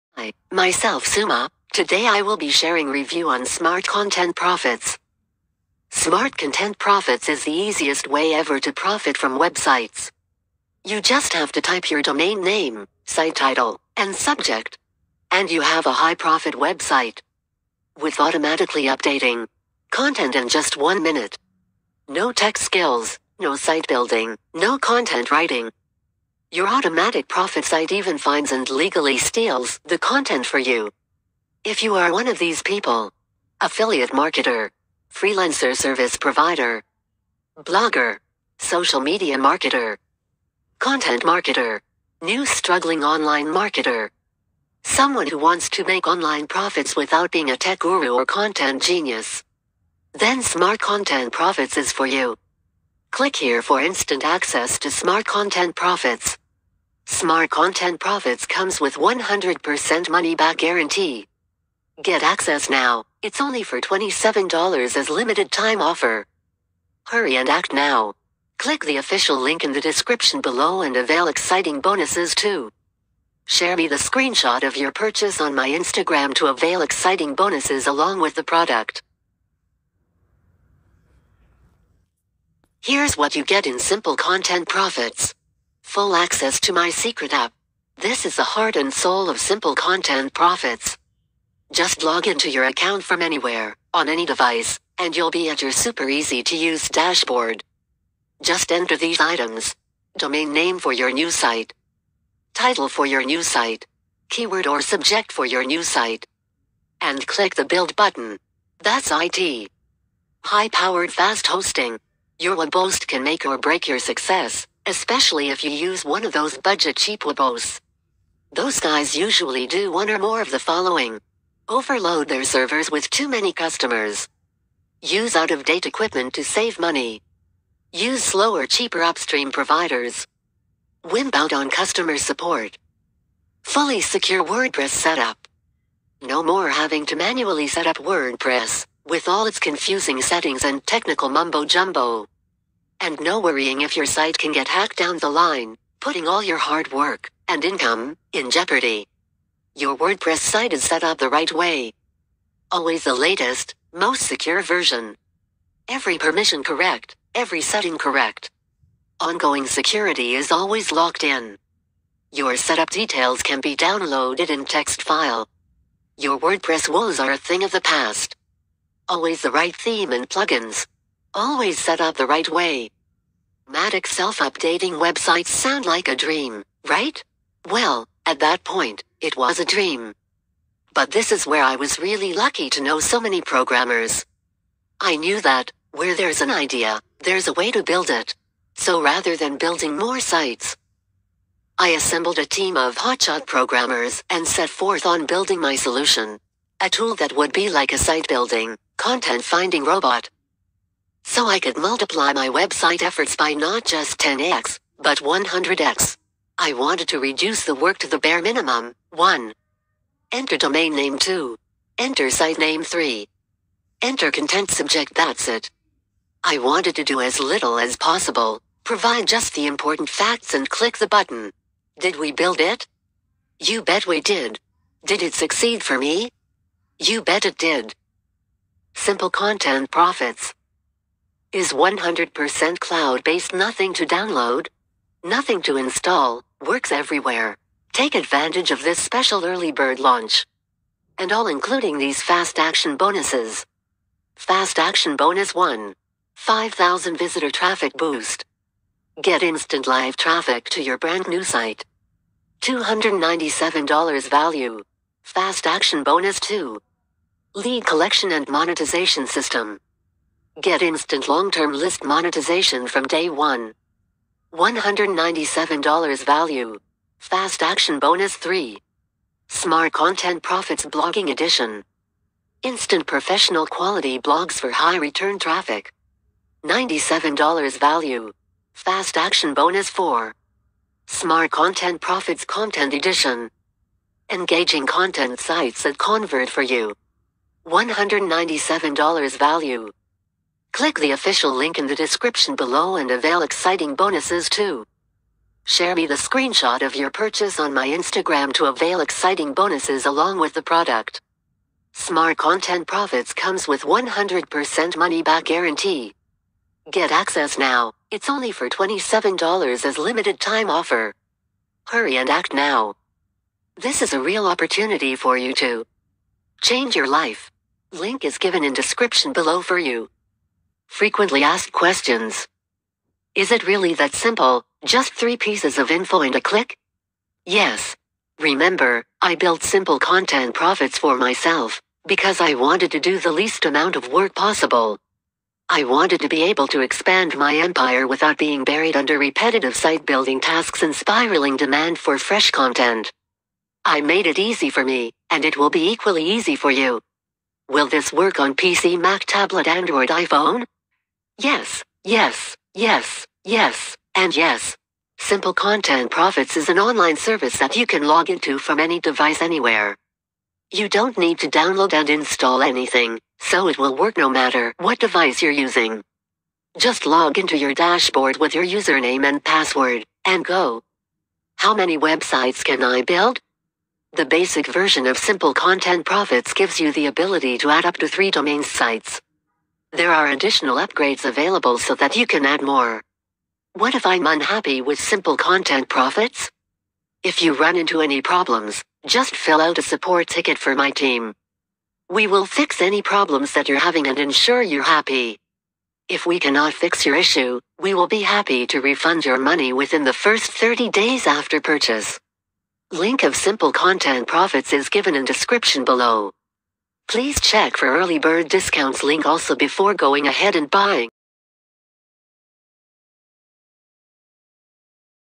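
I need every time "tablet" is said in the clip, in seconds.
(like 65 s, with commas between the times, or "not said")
349 s.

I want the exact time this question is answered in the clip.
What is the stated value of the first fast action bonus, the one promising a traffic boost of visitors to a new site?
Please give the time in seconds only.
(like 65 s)
252 s.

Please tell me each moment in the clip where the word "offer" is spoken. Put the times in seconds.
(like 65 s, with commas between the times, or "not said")
65 s, 310 s.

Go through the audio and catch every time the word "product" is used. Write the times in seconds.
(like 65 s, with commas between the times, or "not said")
78 s, 300 s.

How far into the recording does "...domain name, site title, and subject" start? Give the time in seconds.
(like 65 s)
12 s.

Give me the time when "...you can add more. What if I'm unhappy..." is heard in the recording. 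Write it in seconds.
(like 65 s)
382 s.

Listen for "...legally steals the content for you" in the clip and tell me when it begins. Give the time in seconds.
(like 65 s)
28 s.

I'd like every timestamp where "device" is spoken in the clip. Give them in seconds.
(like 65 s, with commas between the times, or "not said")
94 s, 358 s, 364 s.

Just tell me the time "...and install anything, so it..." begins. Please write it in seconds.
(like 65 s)
361 s.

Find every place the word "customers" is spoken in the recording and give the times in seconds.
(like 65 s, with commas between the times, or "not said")
123 s, 131 s.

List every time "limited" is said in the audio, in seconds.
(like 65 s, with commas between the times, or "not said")
65 s, 309 s.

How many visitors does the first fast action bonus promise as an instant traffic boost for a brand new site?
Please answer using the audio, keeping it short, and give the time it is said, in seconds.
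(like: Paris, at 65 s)
5000, at 246 s.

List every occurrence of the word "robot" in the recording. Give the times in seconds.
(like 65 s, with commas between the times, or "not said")
199 s.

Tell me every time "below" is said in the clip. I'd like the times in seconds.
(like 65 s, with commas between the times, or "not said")
70 s, 292 s, 319 s, 405 s.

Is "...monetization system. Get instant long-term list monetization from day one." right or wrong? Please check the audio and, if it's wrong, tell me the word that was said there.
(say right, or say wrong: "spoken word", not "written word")
right.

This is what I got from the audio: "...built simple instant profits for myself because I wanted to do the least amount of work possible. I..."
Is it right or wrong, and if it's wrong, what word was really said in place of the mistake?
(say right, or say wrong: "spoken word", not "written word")
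wrong: "content", not "instant".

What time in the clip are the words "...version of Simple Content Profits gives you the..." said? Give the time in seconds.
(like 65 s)
374 s.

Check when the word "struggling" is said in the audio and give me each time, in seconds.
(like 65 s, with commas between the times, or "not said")
42 s.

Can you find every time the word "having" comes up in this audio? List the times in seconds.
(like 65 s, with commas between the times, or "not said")
136 s, 393 s.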